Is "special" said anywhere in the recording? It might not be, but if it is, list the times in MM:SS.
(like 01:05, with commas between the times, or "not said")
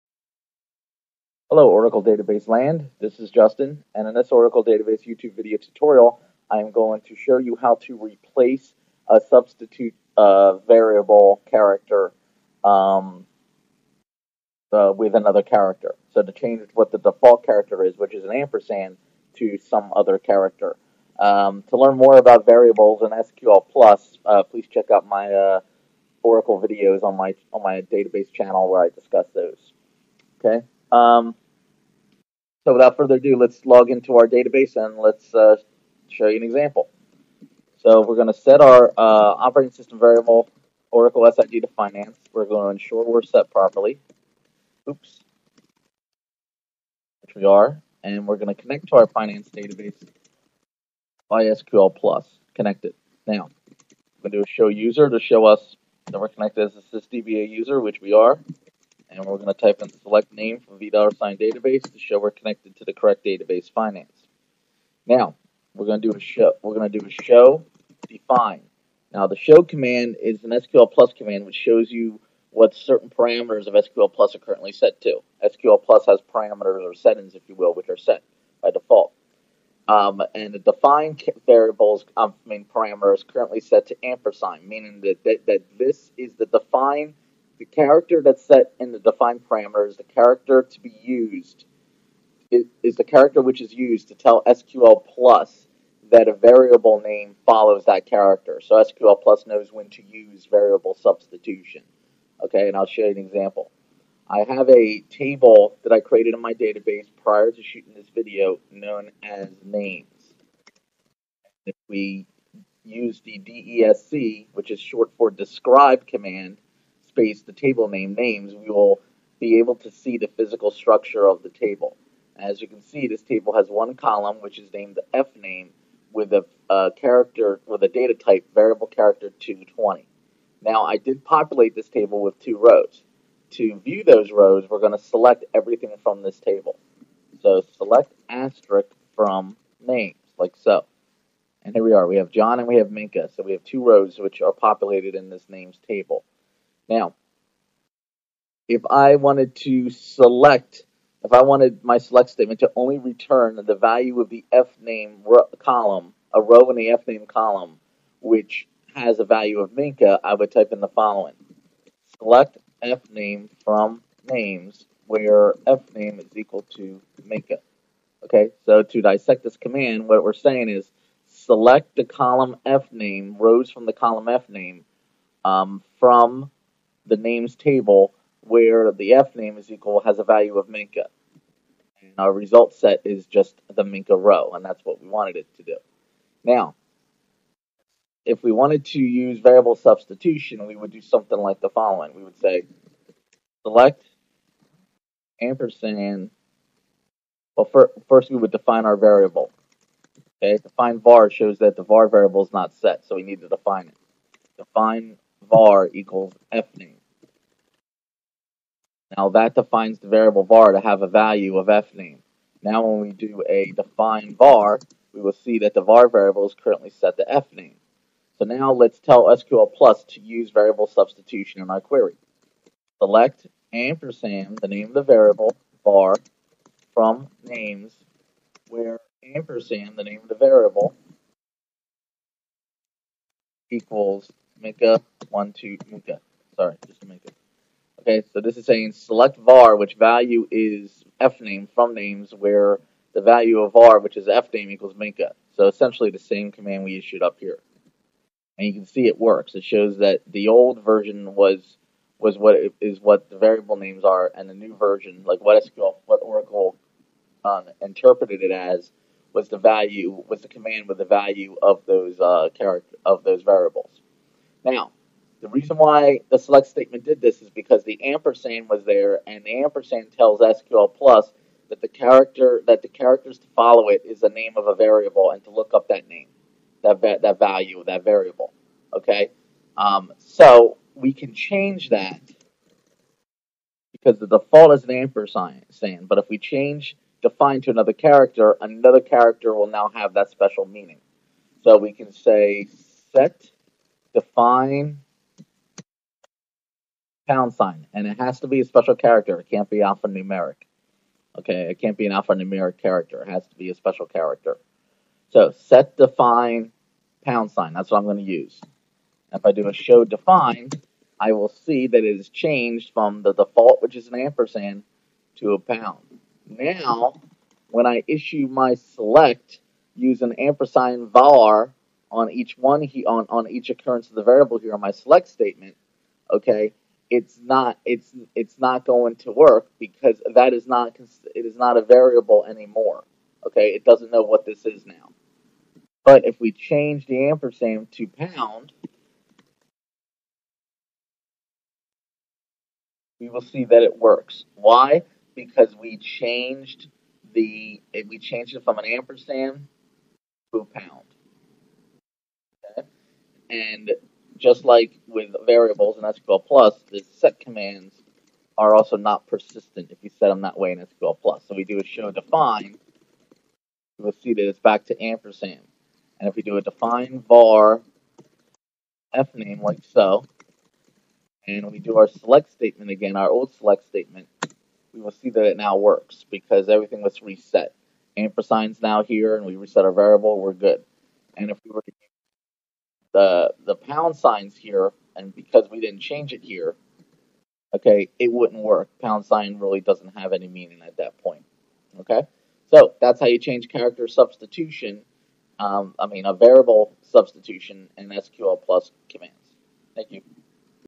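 04:50, 04:58, 05:03.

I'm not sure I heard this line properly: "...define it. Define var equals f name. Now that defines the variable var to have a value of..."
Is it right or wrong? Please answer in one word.
right.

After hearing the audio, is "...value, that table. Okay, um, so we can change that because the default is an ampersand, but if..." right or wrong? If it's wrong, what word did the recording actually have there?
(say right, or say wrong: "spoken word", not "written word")
wrong: "variable", not "table".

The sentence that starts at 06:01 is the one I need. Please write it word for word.
So we do a show define, you will see that it's back to ampersand.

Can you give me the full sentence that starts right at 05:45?
Because we changed the we changed it from an ampersand to a pound.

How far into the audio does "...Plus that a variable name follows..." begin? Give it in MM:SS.
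01:35.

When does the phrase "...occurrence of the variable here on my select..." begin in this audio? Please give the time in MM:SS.
05:23.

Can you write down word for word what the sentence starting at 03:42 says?
Select ampersand, the name of the variable, var, from names where ampersand, the name of the variable, equals Mika one two Mika.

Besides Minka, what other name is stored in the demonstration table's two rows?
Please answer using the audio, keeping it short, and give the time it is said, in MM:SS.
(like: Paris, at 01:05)
John, at 02:22.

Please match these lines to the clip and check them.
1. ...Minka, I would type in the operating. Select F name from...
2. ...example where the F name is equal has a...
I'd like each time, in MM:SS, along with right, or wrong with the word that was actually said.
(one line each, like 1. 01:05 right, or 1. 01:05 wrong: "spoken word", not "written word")
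1. 02:39 wrong: "following", not "operating"
2. 02:57 wrong: "table", not "example".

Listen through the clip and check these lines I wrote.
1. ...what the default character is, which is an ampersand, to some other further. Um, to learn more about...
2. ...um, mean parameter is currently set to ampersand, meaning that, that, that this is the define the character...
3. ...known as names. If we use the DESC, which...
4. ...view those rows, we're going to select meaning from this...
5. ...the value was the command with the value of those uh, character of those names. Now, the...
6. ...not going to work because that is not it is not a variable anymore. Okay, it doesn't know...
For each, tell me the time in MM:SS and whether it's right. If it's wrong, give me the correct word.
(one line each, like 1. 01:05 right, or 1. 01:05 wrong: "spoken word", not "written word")
1. 00:16 wrong: "character", not "further"
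2. 01:22 right
3. 01:48 right
4. 02:13 wrong: "everything", not "meaning"
5. 04:19 wrong: "variables", not "names"
6. 05:28 right.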